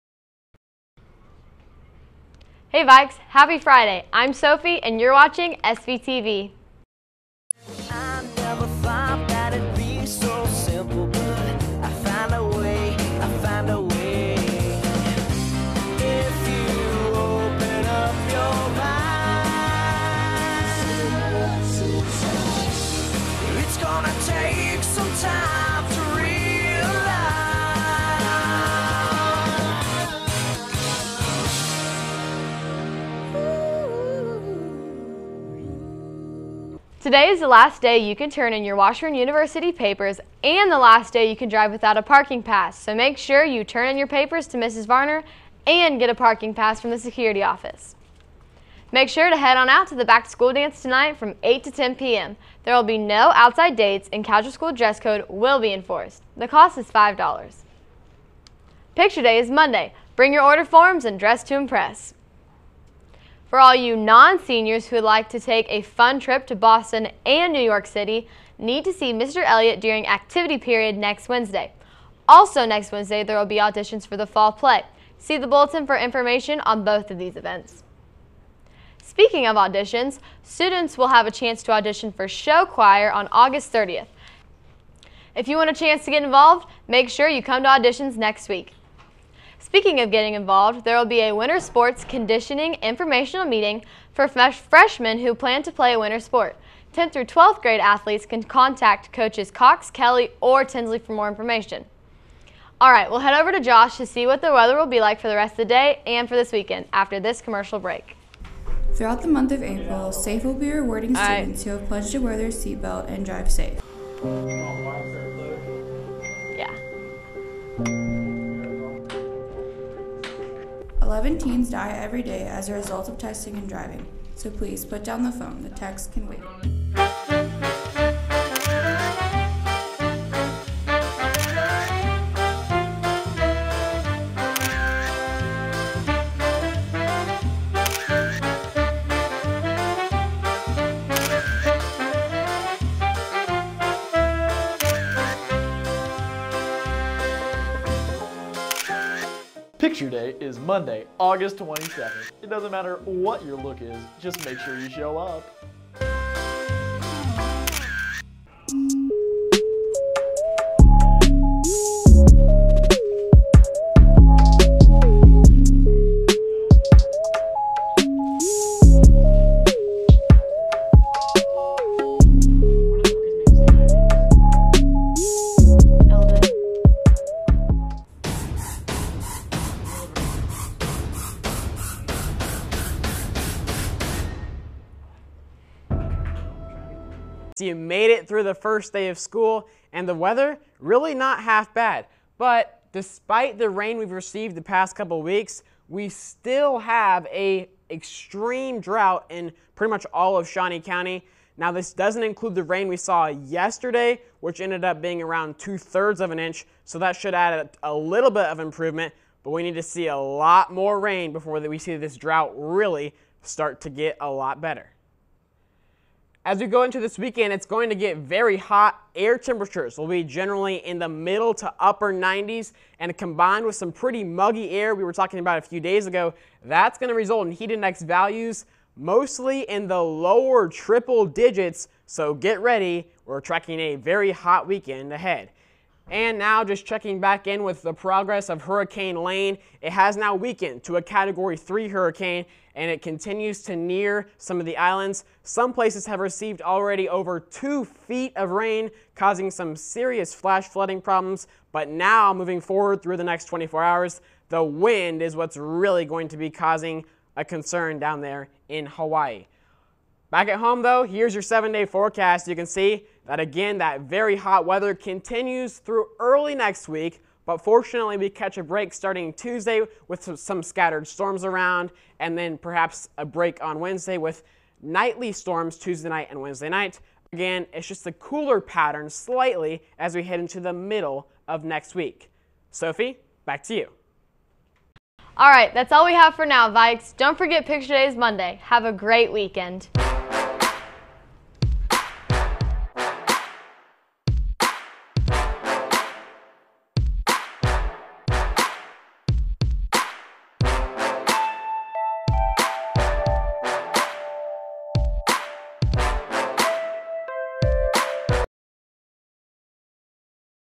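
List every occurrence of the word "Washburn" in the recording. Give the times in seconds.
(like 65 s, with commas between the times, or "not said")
38 s.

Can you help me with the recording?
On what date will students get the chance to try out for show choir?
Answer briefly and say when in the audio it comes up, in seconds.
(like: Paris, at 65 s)
August 30th, at 83 s.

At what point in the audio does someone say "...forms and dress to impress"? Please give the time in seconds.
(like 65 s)
60 s.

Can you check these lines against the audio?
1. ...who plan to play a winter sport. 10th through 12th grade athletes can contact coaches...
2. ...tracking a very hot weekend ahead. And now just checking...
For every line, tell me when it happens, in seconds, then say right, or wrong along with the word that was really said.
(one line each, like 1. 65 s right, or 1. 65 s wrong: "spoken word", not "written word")
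1. 95 s right
2. 233 s right.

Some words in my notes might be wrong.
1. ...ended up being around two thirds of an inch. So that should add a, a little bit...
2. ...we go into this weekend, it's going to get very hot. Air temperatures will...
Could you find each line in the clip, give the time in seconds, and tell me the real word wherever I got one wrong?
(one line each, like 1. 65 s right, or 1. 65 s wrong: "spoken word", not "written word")
1. 204 s right
2. 216 s right.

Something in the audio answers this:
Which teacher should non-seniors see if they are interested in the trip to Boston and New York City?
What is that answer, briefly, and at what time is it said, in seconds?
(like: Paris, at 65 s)
Mr. Elliott, at 69 s.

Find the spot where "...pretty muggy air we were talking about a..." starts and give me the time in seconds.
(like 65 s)
223 s.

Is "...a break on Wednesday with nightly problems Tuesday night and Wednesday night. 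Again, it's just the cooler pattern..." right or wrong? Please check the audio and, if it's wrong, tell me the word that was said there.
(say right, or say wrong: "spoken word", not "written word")
wrong: "storms", not "problems".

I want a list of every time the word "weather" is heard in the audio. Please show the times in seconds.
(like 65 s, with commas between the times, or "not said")
104 s, 190 s, 264 s.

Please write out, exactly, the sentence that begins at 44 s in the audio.
Varner and get a parking pass from the security office.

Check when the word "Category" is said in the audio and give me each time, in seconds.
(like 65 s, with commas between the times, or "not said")
241 s.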